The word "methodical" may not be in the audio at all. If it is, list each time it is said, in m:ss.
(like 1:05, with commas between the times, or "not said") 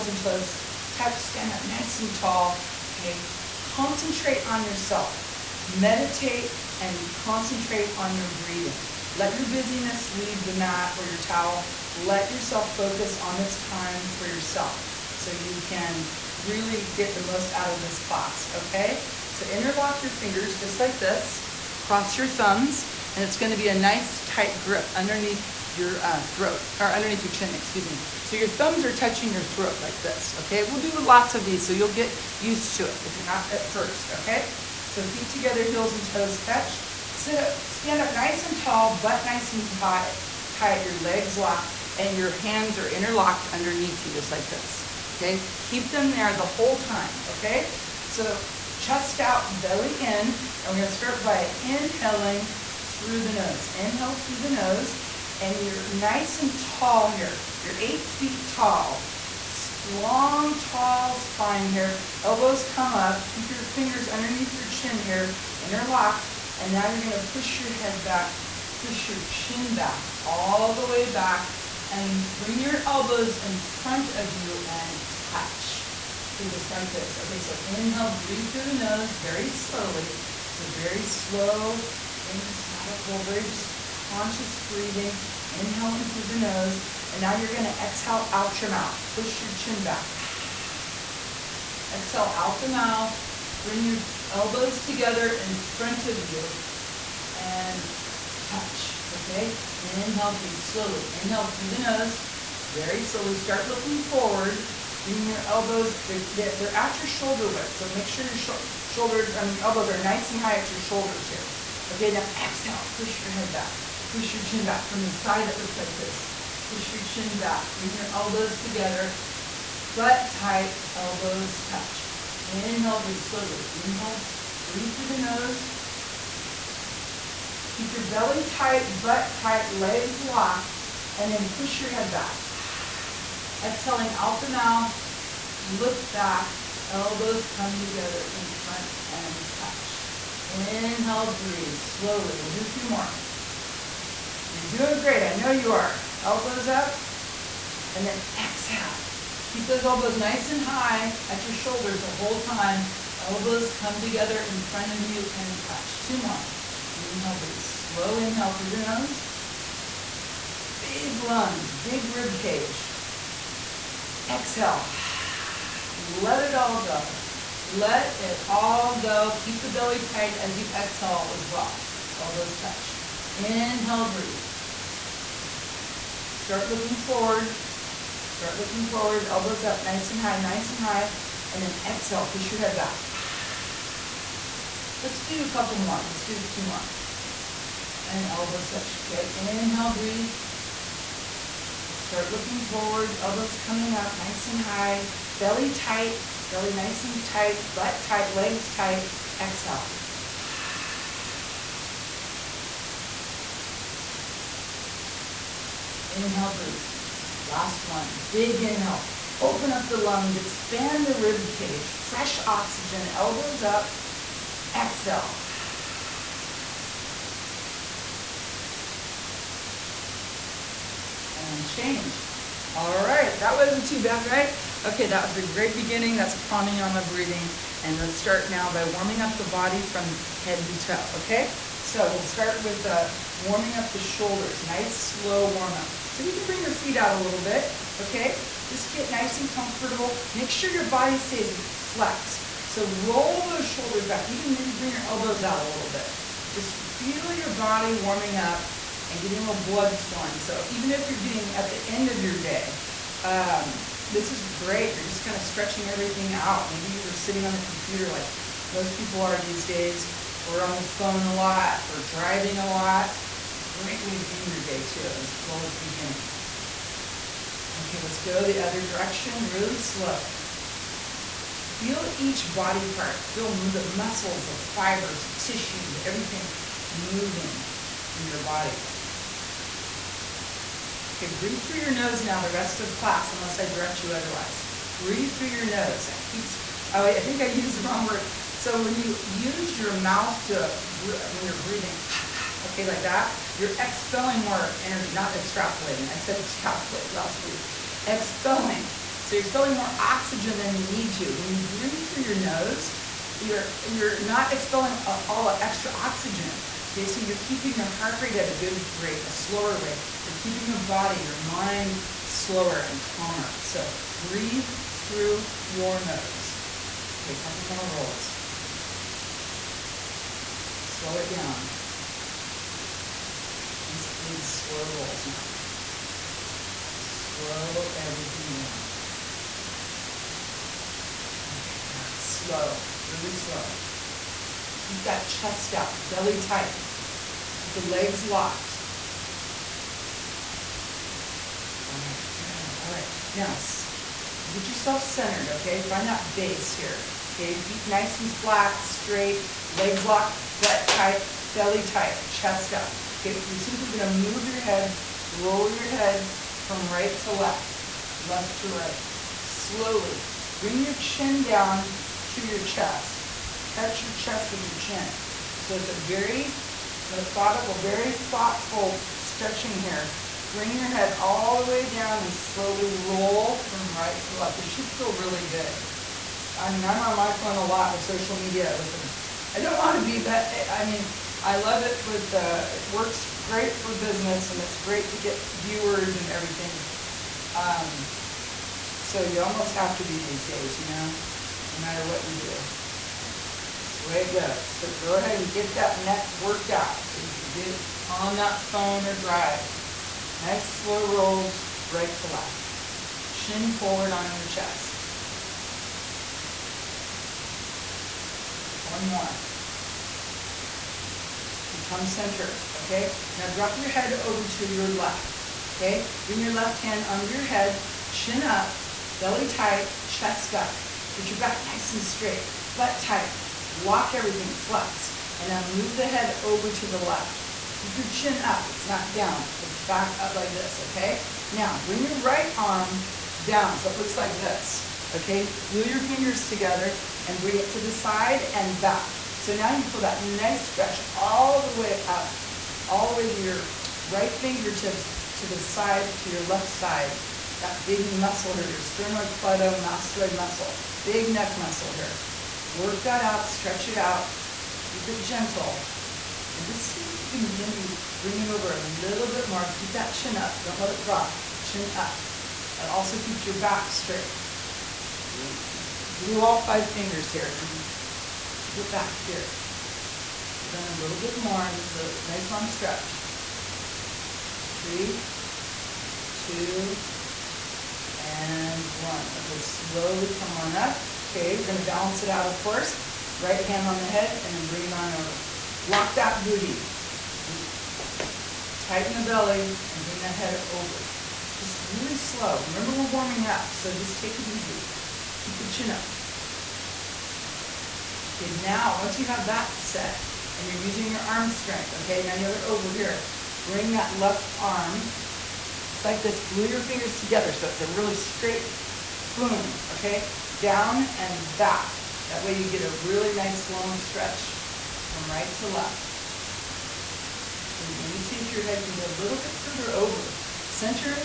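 1:22, 6:07.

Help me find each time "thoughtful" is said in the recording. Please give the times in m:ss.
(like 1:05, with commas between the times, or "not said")
6:08.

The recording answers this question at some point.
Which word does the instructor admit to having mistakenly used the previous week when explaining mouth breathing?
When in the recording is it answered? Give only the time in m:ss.
4:56.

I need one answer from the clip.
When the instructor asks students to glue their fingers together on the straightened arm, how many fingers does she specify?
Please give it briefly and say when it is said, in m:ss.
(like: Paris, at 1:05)
5, at 7:46.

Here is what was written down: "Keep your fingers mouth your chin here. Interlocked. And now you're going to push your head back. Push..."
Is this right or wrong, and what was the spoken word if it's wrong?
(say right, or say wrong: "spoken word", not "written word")
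wrong: "underneath", not "mouth".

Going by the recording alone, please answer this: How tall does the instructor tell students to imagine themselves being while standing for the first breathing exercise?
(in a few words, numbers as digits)
8 feet.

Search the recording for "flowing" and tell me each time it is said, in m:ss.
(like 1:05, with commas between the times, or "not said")
4:09.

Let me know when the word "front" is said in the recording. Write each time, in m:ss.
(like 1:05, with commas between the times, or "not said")
1:13, 1:35, 2:18, 2:34.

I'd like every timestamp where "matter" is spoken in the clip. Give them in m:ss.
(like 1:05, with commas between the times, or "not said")
6:31.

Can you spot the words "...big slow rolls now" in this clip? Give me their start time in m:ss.
5:24.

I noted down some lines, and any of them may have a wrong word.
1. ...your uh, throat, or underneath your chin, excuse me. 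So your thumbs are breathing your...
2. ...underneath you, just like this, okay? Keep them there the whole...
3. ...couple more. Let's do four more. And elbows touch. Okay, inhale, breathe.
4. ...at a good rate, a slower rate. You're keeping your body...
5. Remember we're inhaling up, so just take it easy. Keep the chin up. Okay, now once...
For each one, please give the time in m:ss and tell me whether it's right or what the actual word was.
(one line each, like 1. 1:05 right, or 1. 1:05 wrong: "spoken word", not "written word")
1. 0:25 wrong: "touching", not "breathing"
2. 0:43 right
3. 3:05 wrong: "two", not "four"
4. 5:08 right
5. 8:12 wrong: "warming", not "inhaling".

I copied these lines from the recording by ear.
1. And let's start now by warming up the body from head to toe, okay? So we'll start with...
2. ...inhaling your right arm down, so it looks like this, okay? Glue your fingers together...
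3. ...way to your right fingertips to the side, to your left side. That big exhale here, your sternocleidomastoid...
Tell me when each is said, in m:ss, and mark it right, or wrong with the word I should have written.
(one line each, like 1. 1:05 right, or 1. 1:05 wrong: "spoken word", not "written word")
1. 3:47 right
2. 7:11 wrong: "bring", not "inhaling"
3. 7:23 wrong: "muscle", not "exhale".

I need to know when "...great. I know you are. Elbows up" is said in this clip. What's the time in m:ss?
2:25.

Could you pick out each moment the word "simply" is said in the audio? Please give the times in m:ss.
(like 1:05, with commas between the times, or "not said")
5:53.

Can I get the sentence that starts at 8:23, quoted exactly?
Bring that left arm, just like this, glue your fingers together so it's a really straight boom, okay?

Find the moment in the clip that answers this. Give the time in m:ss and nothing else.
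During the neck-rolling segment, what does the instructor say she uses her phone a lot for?
6:18.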